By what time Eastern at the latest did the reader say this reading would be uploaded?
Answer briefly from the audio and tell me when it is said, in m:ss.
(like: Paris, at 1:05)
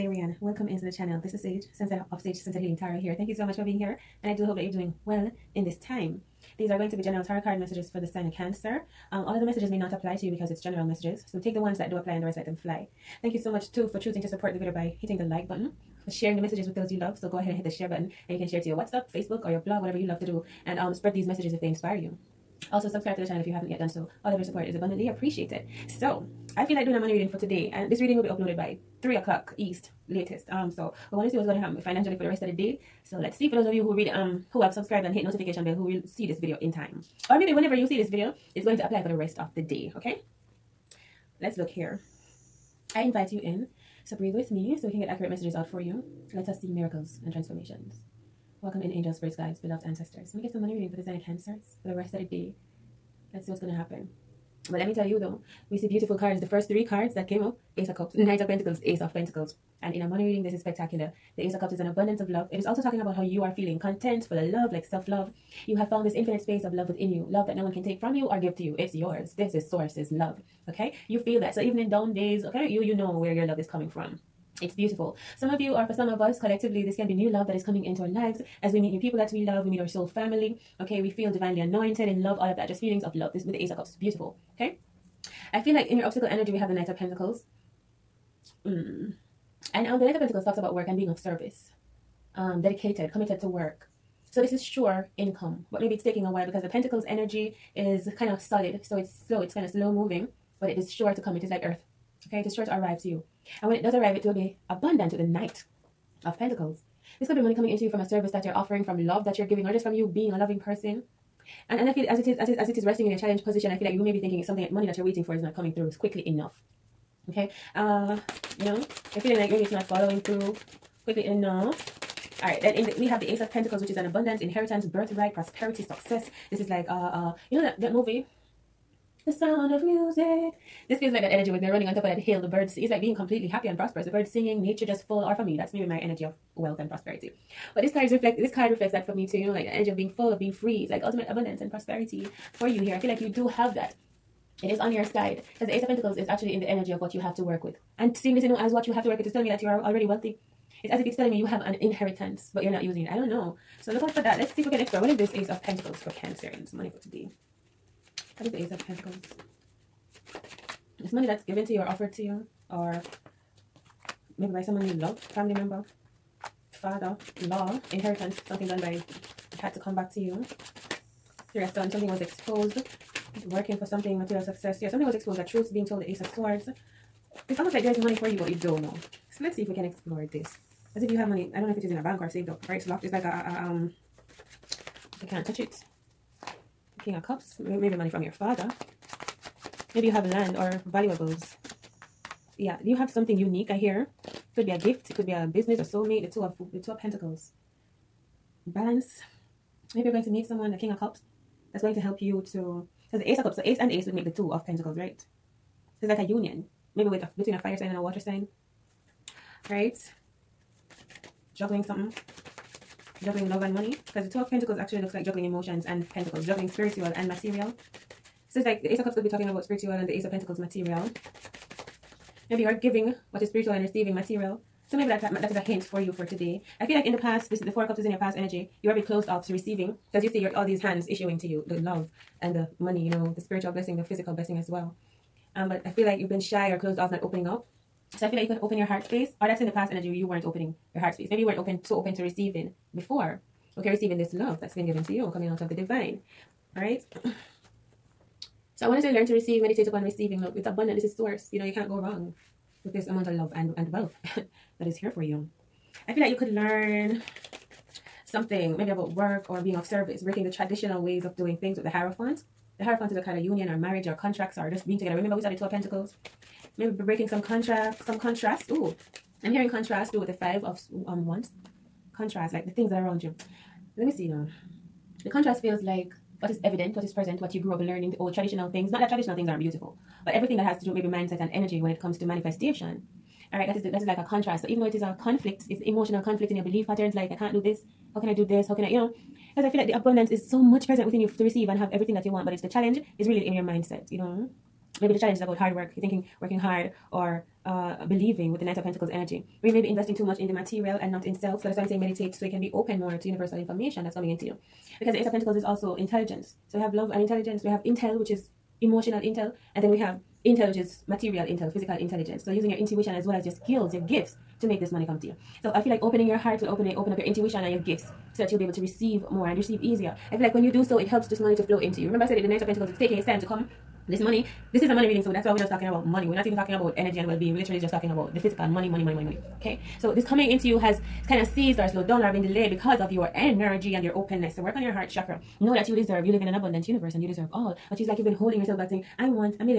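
3 o'clock, at 0:29.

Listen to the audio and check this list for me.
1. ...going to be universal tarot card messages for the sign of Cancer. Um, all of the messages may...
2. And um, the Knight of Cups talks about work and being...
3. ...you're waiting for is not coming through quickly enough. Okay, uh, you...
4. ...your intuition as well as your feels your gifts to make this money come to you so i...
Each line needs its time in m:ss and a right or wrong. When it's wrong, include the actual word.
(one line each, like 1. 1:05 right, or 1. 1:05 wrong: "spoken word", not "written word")
1. 0:06 wrong: "general", not "universal"
2. 1:29 wrong: "Pentacles", not "Cups"
3. 1:54 right
4. 5:12 wrong: "skills", not "feels".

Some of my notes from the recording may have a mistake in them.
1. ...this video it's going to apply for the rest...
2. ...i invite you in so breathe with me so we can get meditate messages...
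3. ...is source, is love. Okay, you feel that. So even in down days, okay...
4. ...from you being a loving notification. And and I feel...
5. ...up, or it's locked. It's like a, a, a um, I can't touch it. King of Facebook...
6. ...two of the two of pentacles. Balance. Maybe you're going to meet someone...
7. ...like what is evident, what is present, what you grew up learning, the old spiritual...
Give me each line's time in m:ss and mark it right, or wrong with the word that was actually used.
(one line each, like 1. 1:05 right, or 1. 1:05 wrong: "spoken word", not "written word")
1. 0:37 right
2. 0:42 wrong: "accurate", not "meditate"
3. 1:09 right
4. 1:49 wrong: "person", not "notification"
5. 3:02 wrong: "Cups", not "Facebook"
6. 3:16 right
7. 4:35 wrong: "traditional", not "spiritual".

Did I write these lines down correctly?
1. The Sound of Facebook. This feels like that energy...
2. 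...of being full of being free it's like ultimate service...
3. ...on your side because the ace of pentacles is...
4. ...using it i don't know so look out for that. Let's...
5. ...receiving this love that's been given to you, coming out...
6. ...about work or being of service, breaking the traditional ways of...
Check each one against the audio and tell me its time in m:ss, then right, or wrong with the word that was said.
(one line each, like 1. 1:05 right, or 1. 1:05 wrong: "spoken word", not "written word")
1. 2:09 wrong: "Music", not "Facebook"
2. 2:19 wrong: "abundance", not "service"
3. 2:24 right
4. 2:32 right
5. 4:03 right
6. 4:18 right.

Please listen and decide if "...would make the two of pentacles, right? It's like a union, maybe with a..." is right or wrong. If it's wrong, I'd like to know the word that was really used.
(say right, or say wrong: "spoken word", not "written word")
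right.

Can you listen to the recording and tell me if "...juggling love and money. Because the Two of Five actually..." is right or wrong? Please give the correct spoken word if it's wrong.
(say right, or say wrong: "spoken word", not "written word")
wrong: "Pentacles", not "Five".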